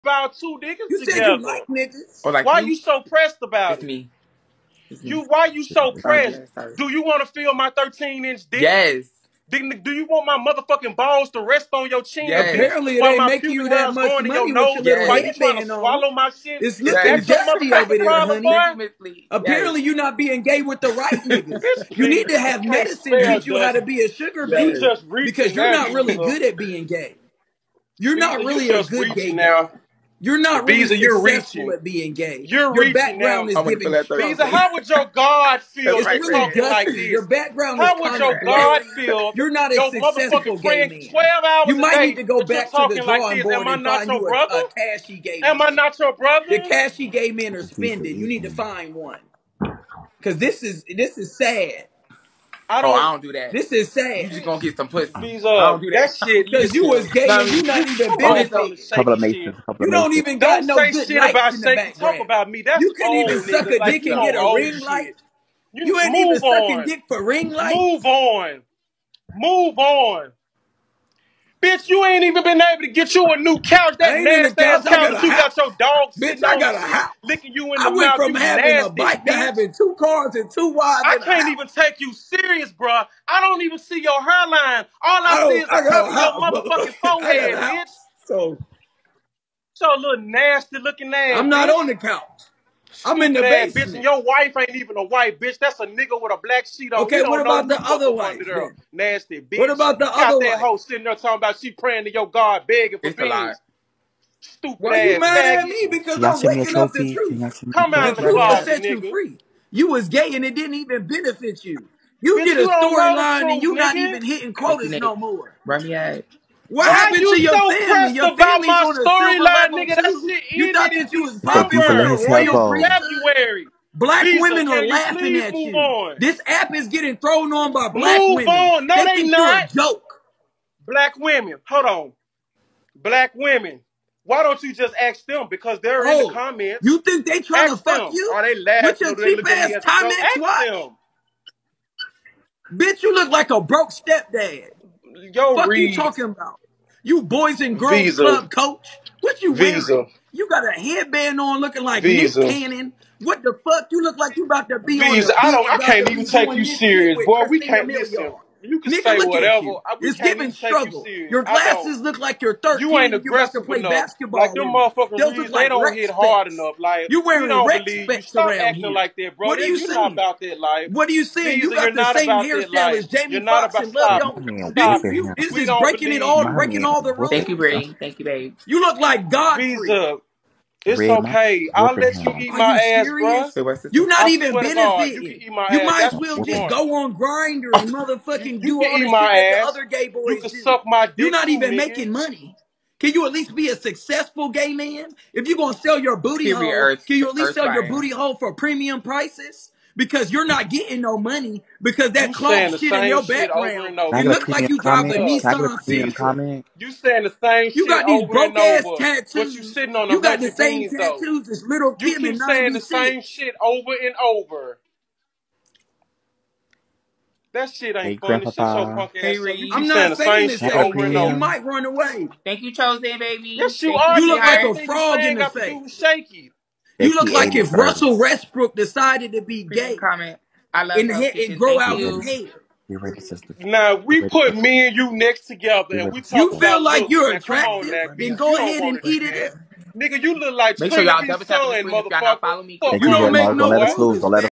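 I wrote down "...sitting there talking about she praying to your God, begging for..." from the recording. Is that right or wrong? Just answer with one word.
right.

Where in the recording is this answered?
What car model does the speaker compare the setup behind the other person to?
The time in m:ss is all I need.
3:24.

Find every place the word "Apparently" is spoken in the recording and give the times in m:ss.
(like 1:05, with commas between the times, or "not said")
0:12, 0:19.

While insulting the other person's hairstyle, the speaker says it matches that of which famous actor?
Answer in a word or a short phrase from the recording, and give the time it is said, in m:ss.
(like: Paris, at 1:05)
Jamie Foxx, at 2:53.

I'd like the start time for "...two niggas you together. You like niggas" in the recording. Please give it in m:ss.
0:00.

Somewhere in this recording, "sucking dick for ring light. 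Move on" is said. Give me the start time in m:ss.
1:06.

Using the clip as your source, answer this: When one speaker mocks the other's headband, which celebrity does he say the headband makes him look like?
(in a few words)
Nick Cannon.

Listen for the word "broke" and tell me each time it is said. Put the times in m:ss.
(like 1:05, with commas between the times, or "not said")
2:23, 3:28.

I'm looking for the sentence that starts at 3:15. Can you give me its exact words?
If you're gonna sell your booty hole, can you at least sell your booty hole for premium prices?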